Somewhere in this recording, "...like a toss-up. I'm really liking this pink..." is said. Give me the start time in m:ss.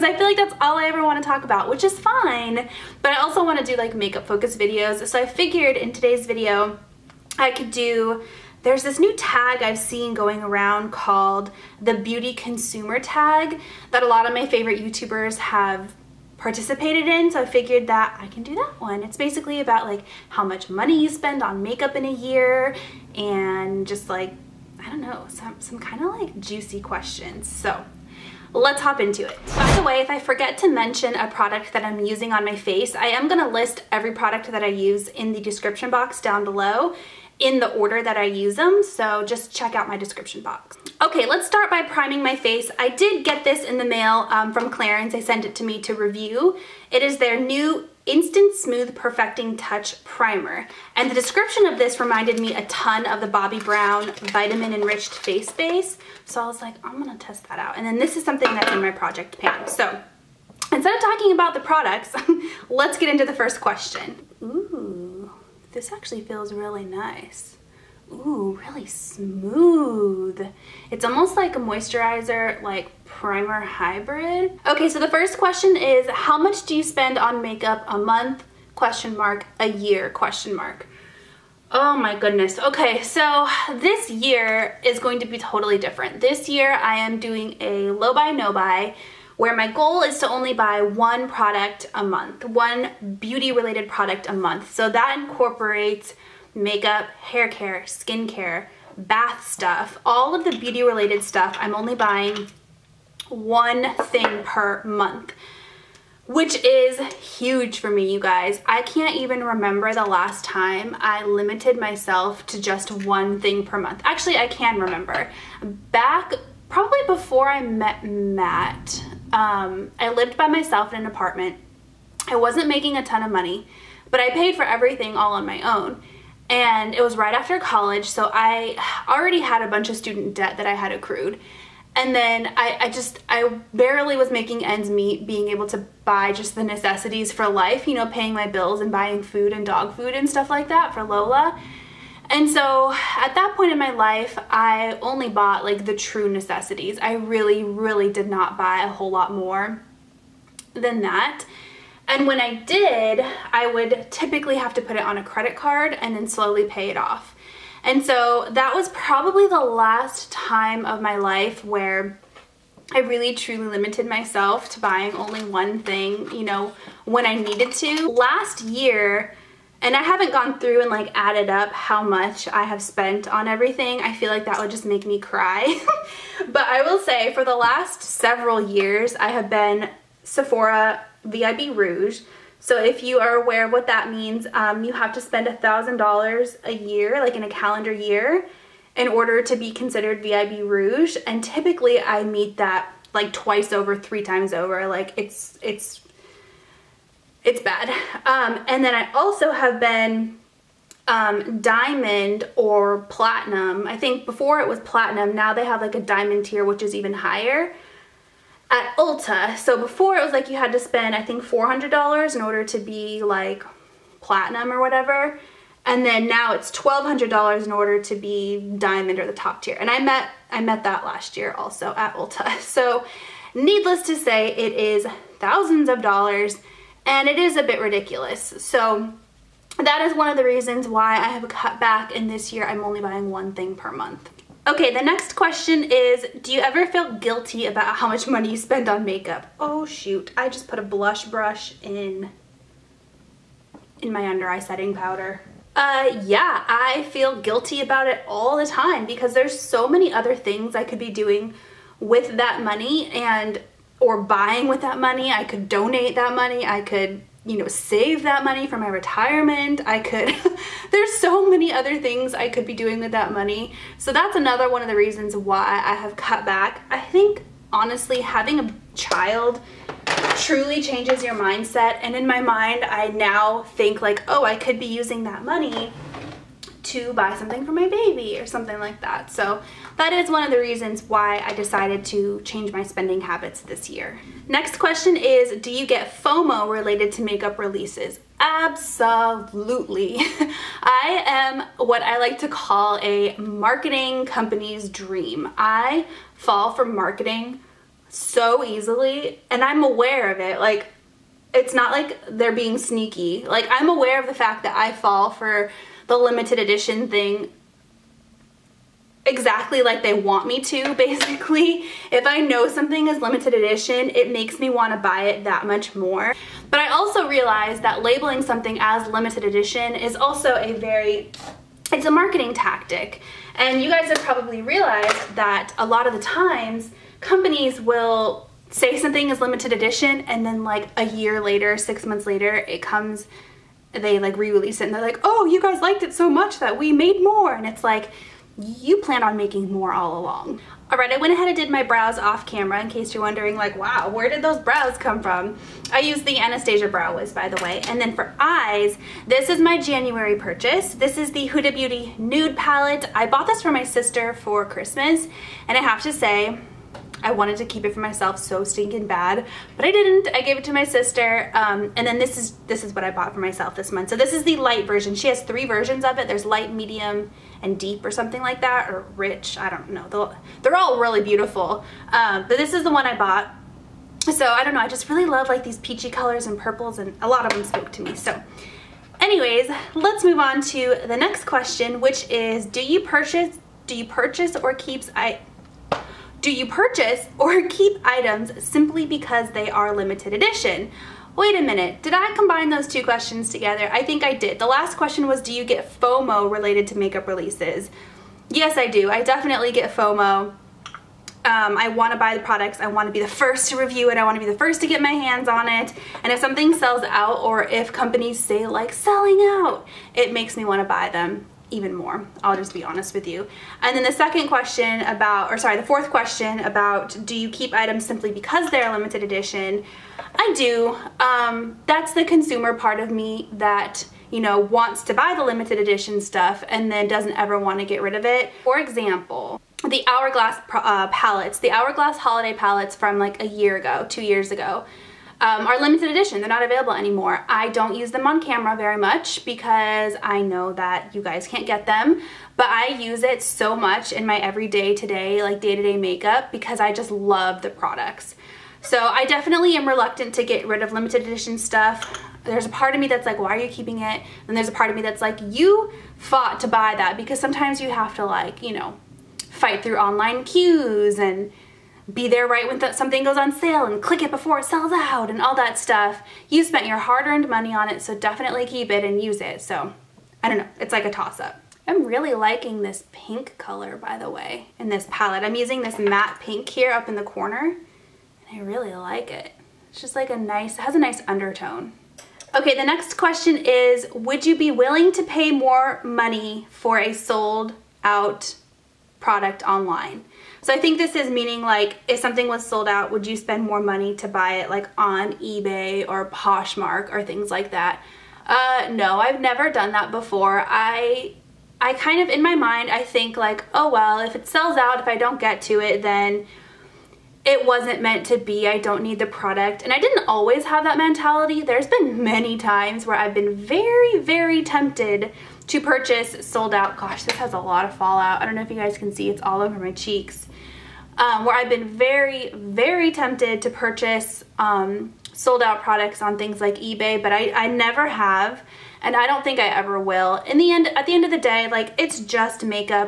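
7:50.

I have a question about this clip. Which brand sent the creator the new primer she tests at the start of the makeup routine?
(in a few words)
Clarins.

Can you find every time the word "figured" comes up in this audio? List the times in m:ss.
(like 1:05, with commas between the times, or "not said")
0:05, 0:17.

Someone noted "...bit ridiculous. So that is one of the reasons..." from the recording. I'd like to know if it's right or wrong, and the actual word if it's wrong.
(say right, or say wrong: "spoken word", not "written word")
right.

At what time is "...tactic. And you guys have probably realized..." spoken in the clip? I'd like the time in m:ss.
5:22.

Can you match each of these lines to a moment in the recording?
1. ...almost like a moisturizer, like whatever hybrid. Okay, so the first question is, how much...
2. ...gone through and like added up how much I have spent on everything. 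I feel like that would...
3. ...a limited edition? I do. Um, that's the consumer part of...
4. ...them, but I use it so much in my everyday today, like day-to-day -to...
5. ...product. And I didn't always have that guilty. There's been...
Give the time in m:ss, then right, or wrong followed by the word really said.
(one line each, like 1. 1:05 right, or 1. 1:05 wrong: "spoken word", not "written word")
1. 1:11 wrong: "primer", not "whatever"
2. 2:50 right
3. 6:58 right
4. 7:21 right
5. 8:29 wrong: "mentality", not "guilty".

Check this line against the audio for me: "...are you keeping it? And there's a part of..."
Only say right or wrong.
right.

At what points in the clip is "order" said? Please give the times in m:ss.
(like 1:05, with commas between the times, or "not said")
0:37, 3:09, 3:32, 3:37.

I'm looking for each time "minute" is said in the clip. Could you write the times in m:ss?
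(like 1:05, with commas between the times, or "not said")
6:31.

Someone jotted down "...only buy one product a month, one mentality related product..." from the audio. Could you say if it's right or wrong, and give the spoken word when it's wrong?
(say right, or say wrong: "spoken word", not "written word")
wrong: "beauty", not "mentality".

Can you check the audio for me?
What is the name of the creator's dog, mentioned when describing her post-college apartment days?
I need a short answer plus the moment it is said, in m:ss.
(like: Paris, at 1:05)
Lola, at 2:21.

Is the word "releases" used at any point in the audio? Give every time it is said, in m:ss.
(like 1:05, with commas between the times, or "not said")
4:47, 5:34, 6:37.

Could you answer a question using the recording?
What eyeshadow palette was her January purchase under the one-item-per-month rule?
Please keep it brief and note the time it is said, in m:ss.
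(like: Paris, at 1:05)
Huda Beauty Nude Palette, at 5:51.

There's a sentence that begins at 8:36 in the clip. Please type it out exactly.
Gosh, this has a lot of fallout.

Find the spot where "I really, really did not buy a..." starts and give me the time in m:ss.
2:27.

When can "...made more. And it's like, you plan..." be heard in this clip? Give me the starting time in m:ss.
5:36.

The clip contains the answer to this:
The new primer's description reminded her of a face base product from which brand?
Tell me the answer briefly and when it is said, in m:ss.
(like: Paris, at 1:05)
Bobbi Brown, at 0:53.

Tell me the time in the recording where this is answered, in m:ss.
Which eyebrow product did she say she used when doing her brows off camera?
5:46.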